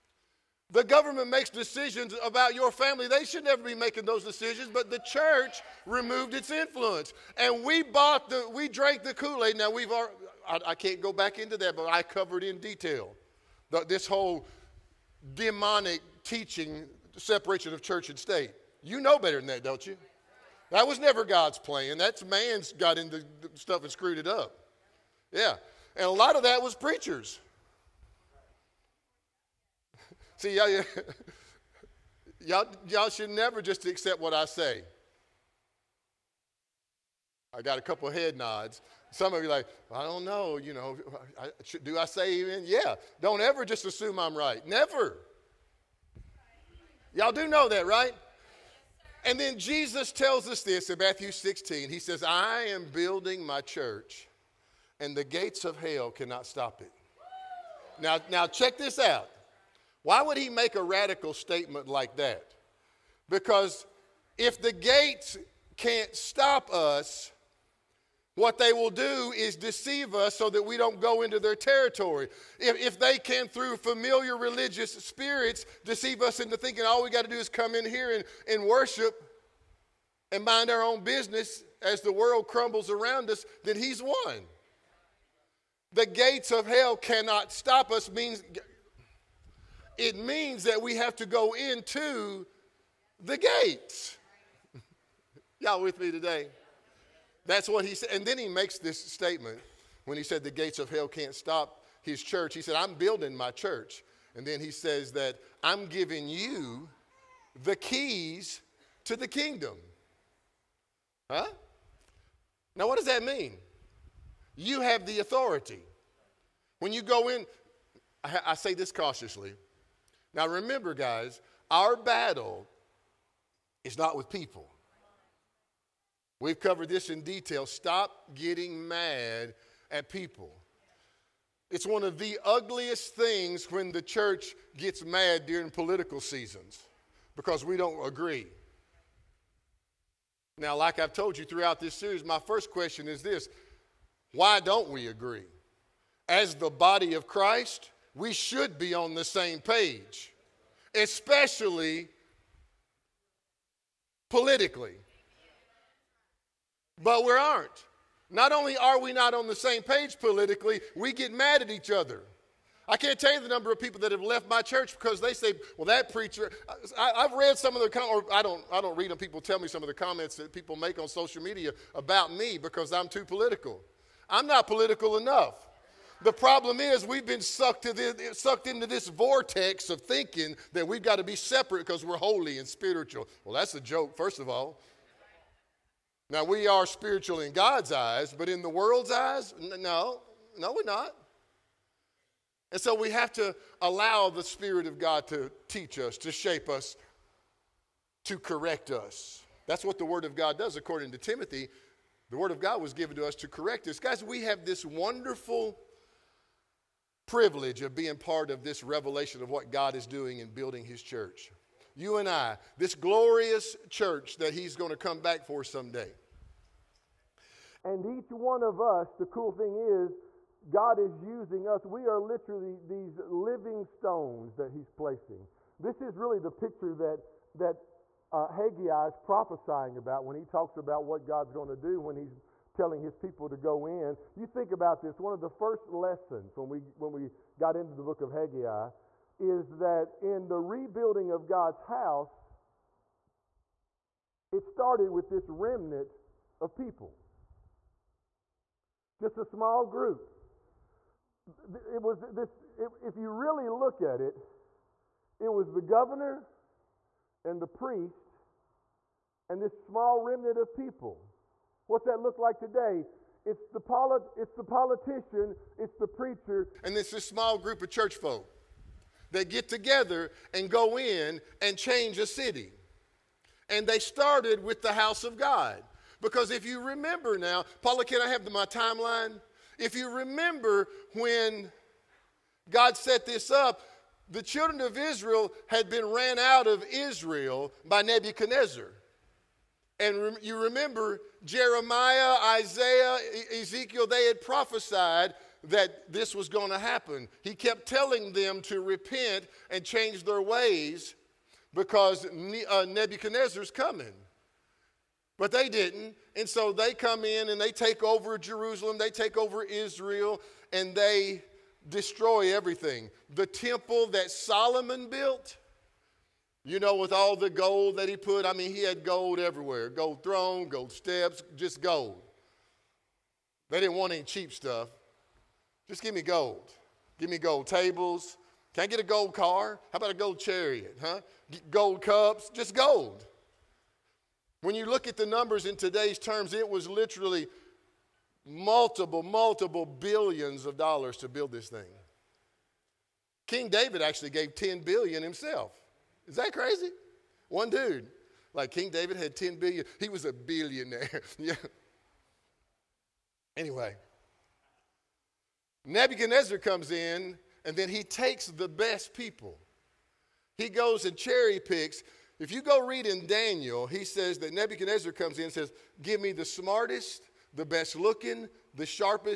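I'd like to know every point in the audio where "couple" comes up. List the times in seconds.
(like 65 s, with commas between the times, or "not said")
37 s.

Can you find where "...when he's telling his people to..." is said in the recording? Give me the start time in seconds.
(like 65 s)
232 s.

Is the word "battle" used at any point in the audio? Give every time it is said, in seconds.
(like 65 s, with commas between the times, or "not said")
121 s.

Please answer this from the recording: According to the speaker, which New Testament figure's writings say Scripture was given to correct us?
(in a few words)
Timothy.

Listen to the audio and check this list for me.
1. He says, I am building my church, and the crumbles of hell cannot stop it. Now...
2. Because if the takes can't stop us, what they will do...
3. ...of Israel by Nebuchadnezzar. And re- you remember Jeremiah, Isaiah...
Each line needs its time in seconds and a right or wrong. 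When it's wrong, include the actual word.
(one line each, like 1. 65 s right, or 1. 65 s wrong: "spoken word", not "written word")
1. 51 s wrong: "gates", not "crumbles"
2. 63 s wrong: "gates", not "takes"
3. 286 s right.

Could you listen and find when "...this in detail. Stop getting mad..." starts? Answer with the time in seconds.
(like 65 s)
126 s.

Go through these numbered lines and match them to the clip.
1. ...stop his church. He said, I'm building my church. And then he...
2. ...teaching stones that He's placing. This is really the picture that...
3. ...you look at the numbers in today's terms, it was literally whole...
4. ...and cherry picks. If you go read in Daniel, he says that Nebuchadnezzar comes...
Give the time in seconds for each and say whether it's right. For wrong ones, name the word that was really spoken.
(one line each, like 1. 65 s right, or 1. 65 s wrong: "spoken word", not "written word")
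1. 101 s right
2. 223 s wrong: "living", not "teaching"
3. 334 s wrong: "multiple", not "whole"
4. 361 s right.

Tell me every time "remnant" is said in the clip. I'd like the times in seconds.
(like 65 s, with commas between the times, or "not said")
245 s, 260 s.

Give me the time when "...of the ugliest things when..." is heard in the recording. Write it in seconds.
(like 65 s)
132 s.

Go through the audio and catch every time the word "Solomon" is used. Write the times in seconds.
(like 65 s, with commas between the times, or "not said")
314 s.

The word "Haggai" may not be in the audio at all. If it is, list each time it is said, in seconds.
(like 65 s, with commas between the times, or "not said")
228 s, 238 s.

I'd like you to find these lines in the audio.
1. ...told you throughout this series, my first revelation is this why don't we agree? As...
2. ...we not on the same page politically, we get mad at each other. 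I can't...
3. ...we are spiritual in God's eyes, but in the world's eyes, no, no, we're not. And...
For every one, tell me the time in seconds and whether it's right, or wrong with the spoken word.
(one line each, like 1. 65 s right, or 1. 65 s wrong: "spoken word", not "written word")
1. 141 s wrong: "question", not "revelation"
2. 158 s right
3. 186 s right.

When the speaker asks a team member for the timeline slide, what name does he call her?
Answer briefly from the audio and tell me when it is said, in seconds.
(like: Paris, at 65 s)
Paula, at 277 s.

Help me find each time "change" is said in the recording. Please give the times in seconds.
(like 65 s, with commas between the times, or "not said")
271 s, 299 s.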